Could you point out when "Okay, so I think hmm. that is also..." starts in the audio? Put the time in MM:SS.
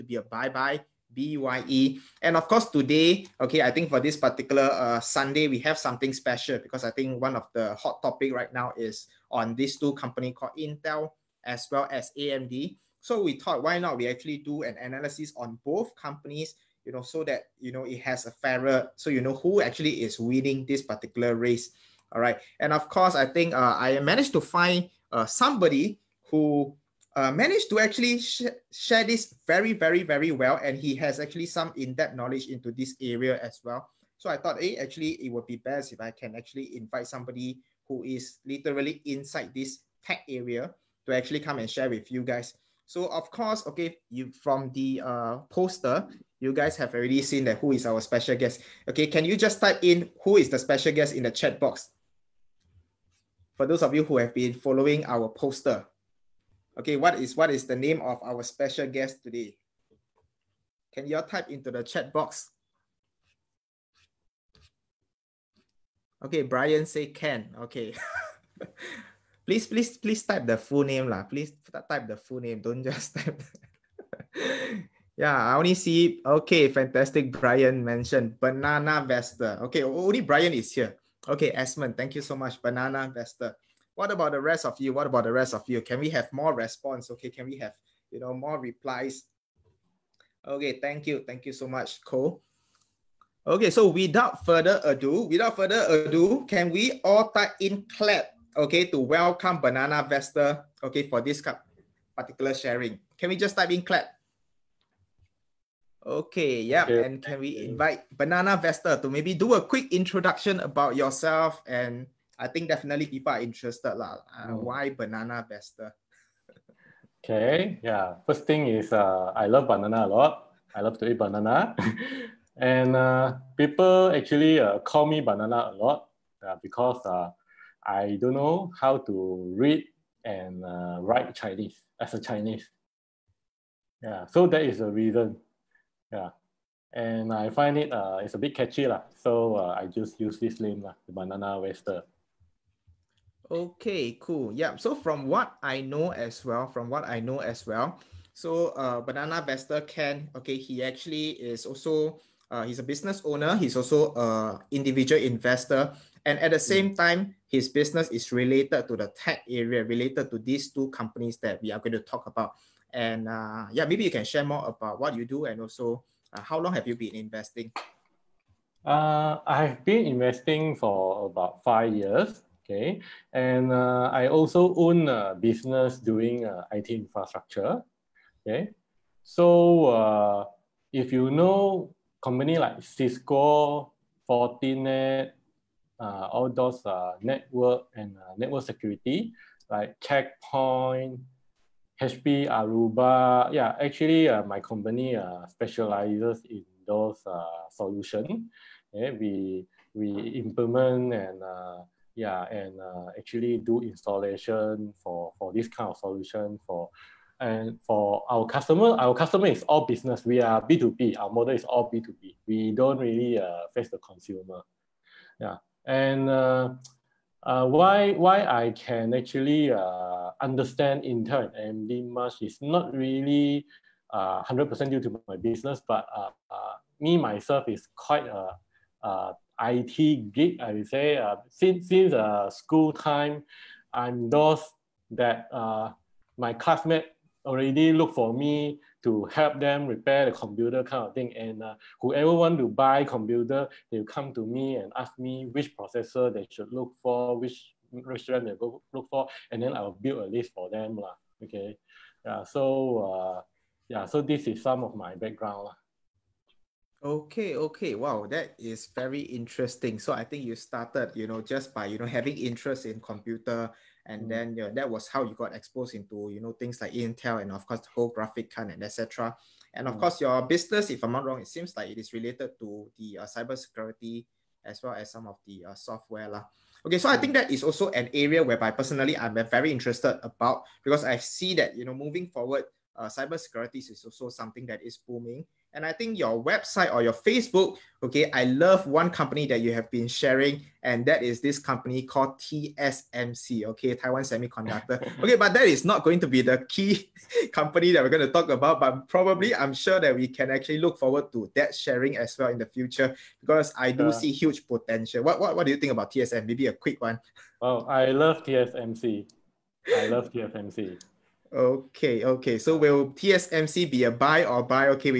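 04:36.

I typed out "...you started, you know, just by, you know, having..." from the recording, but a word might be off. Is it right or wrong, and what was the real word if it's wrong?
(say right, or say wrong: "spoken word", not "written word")
right.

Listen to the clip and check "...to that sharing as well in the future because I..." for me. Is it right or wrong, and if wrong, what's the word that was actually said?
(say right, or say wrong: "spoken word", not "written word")
right.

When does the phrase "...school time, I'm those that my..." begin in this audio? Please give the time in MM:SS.
03:52.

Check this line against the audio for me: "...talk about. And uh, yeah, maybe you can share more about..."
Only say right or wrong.
right.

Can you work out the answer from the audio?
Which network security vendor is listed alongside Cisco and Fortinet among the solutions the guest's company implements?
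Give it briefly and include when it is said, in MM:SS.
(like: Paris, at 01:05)
Checkpoint, at 03:10.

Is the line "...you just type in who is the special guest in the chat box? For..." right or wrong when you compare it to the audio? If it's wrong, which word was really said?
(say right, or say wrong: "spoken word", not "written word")
right.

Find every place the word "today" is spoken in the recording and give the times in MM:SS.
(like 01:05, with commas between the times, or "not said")
00:02, 00:59.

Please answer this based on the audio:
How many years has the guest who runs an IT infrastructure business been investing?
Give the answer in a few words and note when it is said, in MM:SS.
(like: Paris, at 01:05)
5 years, at 02:51.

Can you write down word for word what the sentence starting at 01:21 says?
Okay, Esmond, thank you so much.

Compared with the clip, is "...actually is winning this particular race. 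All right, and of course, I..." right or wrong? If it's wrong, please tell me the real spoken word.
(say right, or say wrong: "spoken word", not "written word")
right.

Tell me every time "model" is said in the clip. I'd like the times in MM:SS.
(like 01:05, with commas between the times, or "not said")
03:31.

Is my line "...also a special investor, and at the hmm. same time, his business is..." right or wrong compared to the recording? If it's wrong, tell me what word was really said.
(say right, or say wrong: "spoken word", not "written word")
wrong: "individual", not "special".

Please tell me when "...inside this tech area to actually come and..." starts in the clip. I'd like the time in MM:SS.
00:39.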